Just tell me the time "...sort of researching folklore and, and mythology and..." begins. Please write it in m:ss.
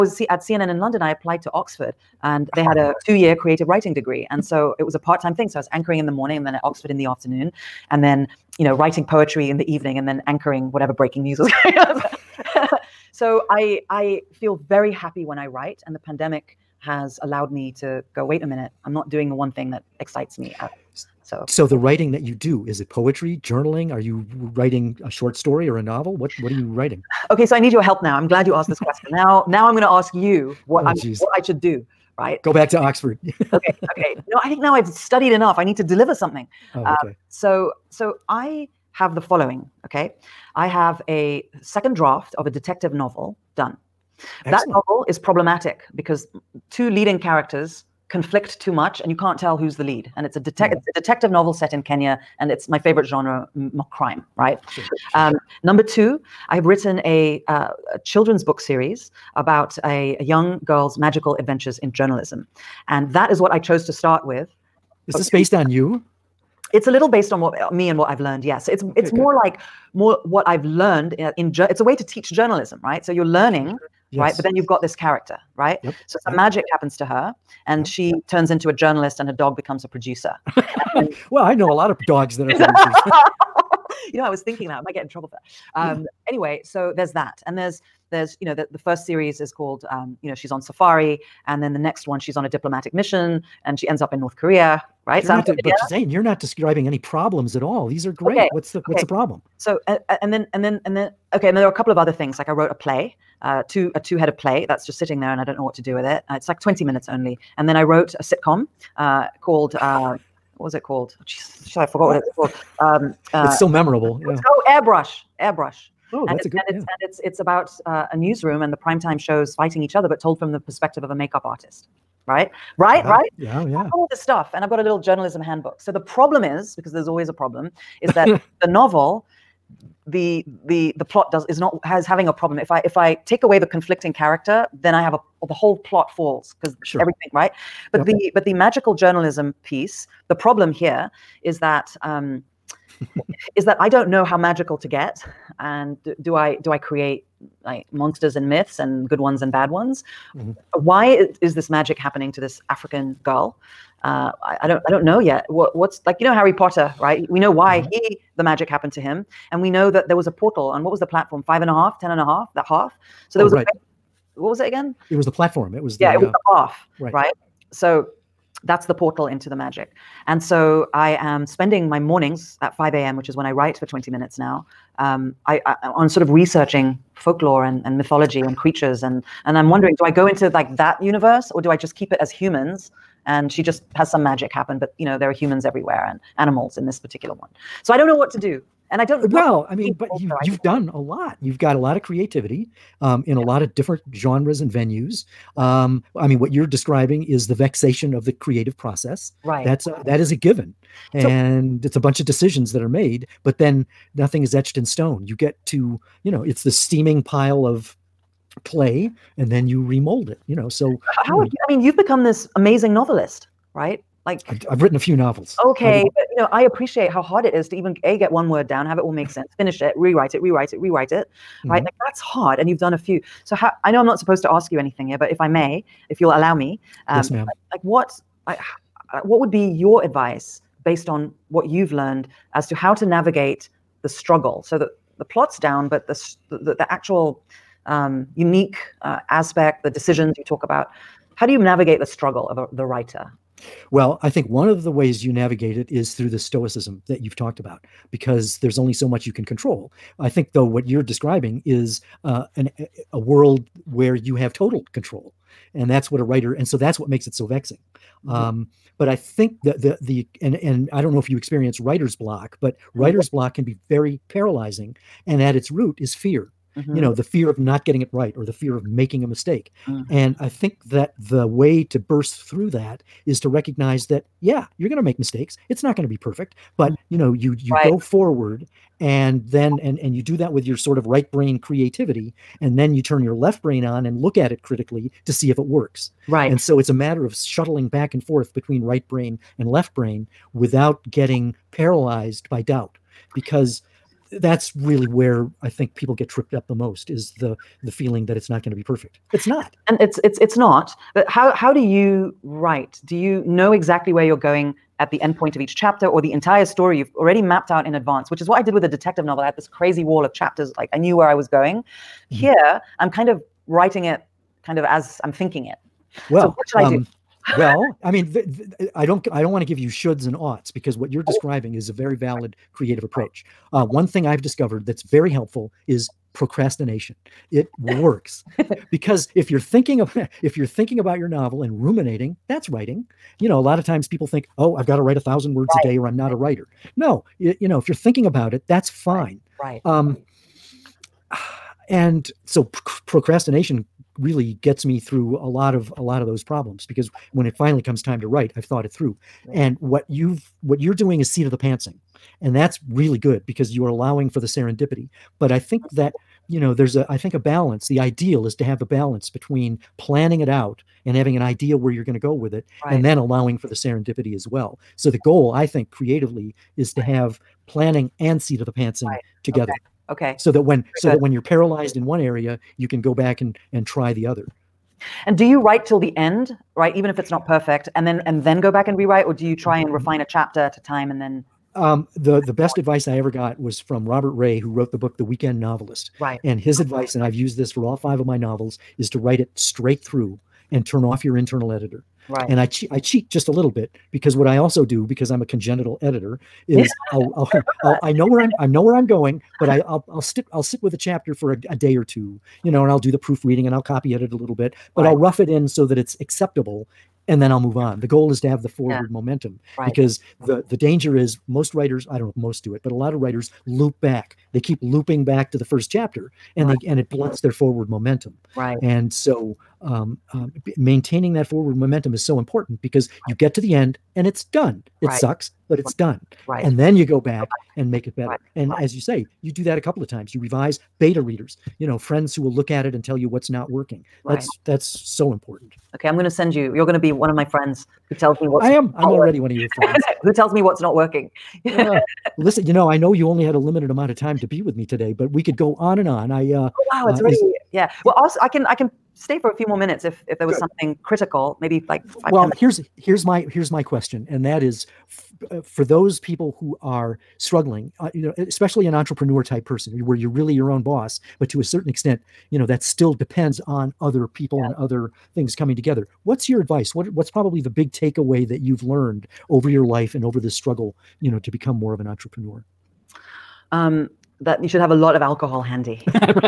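2:56.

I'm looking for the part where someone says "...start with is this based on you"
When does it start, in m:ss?
1:03.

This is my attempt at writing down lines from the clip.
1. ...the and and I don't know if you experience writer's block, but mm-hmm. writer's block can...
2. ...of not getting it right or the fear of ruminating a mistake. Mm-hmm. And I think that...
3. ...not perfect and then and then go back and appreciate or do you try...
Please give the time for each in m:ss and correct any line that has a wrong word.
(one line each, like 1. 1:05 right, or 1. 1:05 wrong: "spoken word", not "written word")
1. 4:20 right
2. 4:27 wrong: "making", not "ruminating"
3. 6:17 wrong: "rewrite", not "appreciate".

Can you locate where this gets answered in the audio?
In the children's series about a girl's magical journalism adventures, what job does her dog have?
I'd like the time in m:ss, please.
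1:19.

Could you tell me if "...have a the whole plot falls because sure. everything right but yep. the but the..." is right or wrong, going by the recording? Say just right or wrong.
right.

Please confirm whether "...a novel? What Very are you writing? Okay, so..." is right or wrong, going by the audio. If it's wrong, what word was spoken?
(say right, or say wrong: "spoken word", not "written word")
wrong: "What", not "Very".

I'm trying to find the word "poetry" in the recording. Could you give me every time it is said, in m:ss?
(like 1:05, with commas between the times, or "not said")
0:09, 0:22.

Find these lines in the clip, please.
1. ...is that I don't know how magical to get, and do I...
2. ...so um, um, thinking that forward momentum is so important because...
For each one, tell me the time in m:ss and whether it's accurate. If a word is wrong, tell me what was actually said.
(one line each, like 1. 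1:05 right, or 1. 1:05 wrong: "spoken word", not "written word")
1. 2:23 right
2. 6:59 wrong: "maintaining", not "thinking".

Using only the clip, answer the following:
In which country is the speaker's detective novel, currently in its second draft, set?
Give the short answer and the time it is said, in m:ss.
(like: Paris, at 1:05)
Kenya, at 0:51.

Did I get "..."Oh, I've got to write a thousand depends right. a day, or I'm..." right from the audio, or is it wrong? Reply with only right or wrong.
wrong.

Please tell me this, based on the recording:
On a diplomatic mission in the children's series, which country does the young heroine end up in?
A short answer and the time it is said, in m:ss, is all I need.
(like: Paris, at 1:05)
North Korea, at 1:34.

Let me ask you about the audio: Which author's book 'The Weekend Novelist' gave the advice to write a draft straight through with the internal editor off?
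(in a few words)
Robert Ray.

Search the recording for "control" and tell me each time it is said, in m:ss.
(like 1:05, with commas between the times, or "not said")
4:09, 4:14.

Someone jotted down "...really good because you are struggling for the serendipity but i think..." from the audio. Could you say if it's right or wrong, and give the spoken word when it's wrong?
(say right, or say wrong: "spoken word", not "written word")
wrong: "allowing", not "struggling".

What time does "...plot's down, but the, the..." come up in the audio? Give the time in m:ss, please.
3:55.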